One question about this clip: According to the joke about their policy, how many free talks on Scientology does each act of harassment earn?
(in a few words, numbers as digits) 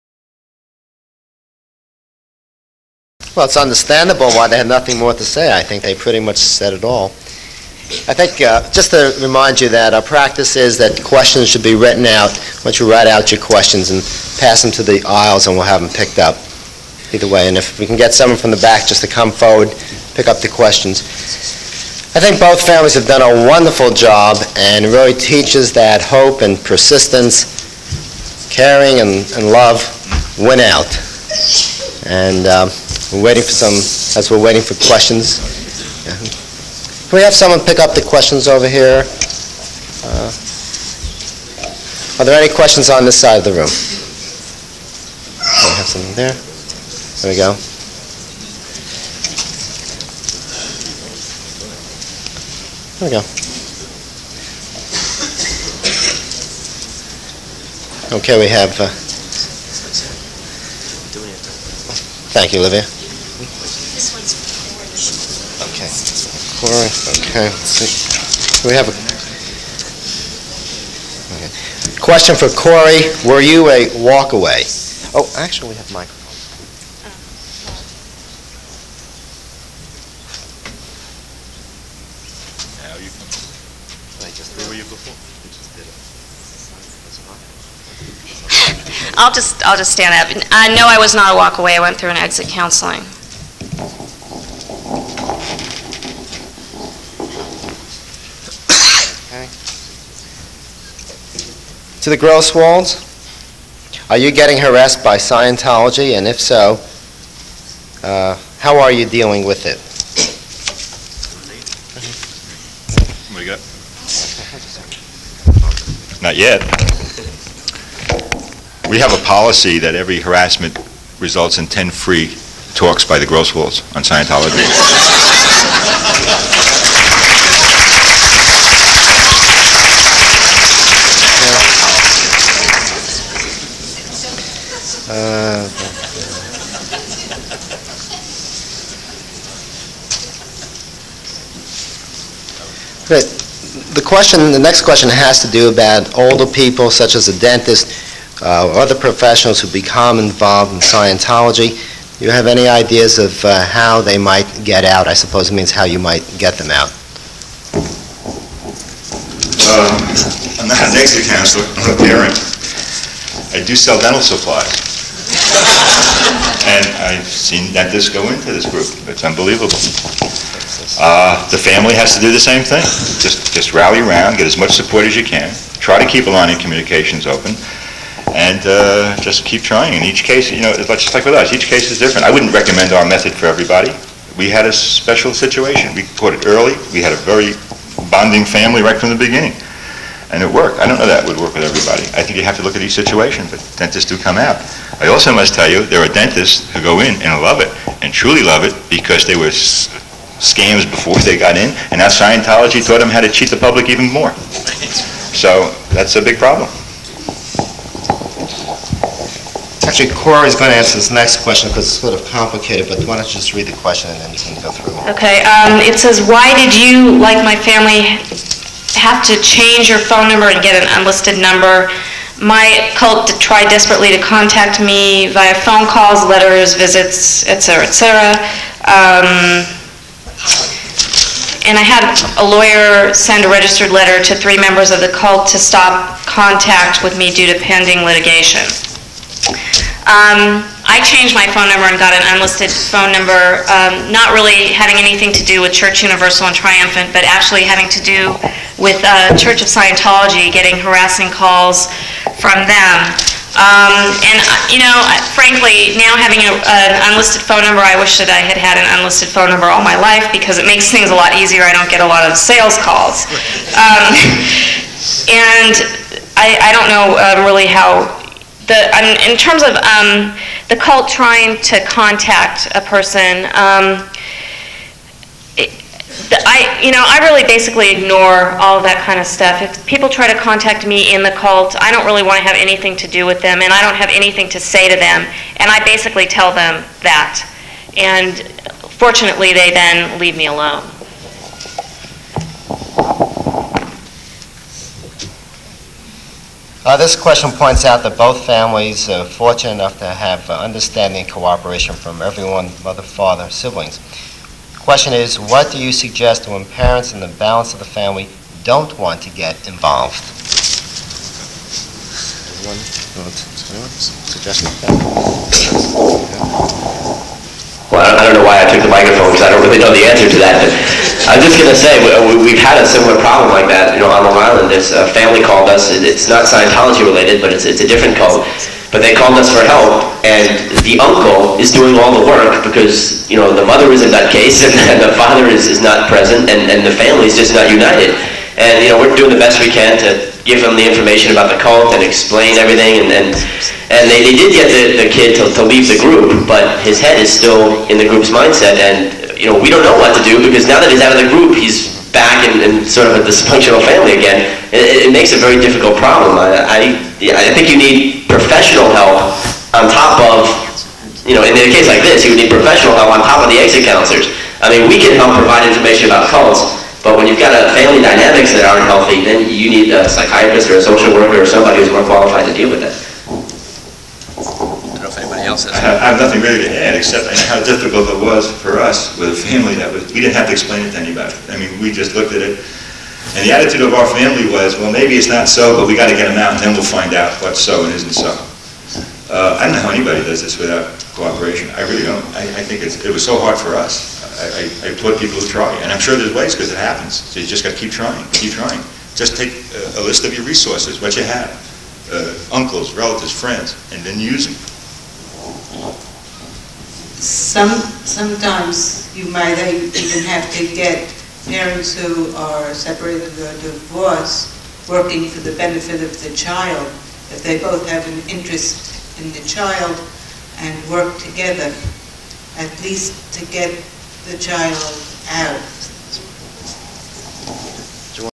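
10.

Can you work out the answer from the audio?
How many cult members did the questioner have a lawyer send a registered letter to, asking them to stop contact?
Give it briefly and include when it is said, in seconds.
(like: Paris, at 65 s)
3, at 234 s.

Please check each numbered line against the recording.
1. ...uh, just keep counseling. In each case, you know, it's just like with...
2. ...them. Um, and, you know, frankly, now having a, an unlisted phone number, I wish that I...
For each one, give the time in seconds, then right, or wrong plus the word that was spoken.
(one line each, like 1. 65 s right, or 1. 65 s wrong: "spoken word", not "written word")
1. 178 s wrong: "trying", not "counseling"
2. 252 s right.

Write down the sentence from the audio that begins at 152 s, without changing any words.
Do you have any ideas of uh, how they might get out?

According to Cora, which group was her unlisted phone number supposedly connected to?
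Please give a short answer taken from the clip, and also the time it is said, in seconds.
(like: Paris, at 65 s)
Church Universal and Triumphant, at 245 s.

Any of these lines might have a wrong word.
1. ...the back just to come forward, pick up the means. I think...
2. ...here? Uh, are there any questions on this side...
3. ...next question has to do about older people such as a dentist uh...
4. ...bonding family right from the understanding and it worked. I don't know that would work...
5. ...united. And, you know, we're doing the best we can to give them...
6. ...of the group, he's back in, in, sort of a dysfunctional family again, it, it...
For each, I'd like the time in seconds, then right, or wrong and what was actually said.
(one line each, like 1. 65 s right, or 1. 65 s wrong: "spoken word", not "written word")
1. 18 s wrong: "questions", not "means"
2. 38 s right
3. 144 s right
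4. 188 s wrong: "beginning", not "understanding"
5. 337 s right
6. 351 s right.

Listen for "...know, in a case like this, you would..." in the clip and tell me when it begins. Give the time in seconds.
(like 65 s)
361 s.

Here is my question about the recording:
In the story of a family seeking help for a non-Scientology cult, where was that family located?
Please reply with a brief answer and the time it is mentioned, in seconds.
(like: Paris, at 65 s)
Long Island, at 324 s.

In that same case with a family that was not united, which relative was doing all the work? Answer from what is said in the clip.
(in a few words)
the uncle.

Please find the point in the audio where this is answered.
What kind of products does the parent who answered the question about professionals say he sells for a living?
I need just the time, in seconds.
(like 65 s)
163 s.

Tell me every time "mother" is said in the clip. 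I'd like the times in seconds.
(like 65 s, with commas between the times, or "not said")
302 s, 333 s.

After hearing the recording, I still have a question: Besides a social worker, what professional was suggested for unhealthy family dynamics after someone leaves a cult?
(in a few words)
psychiatrist.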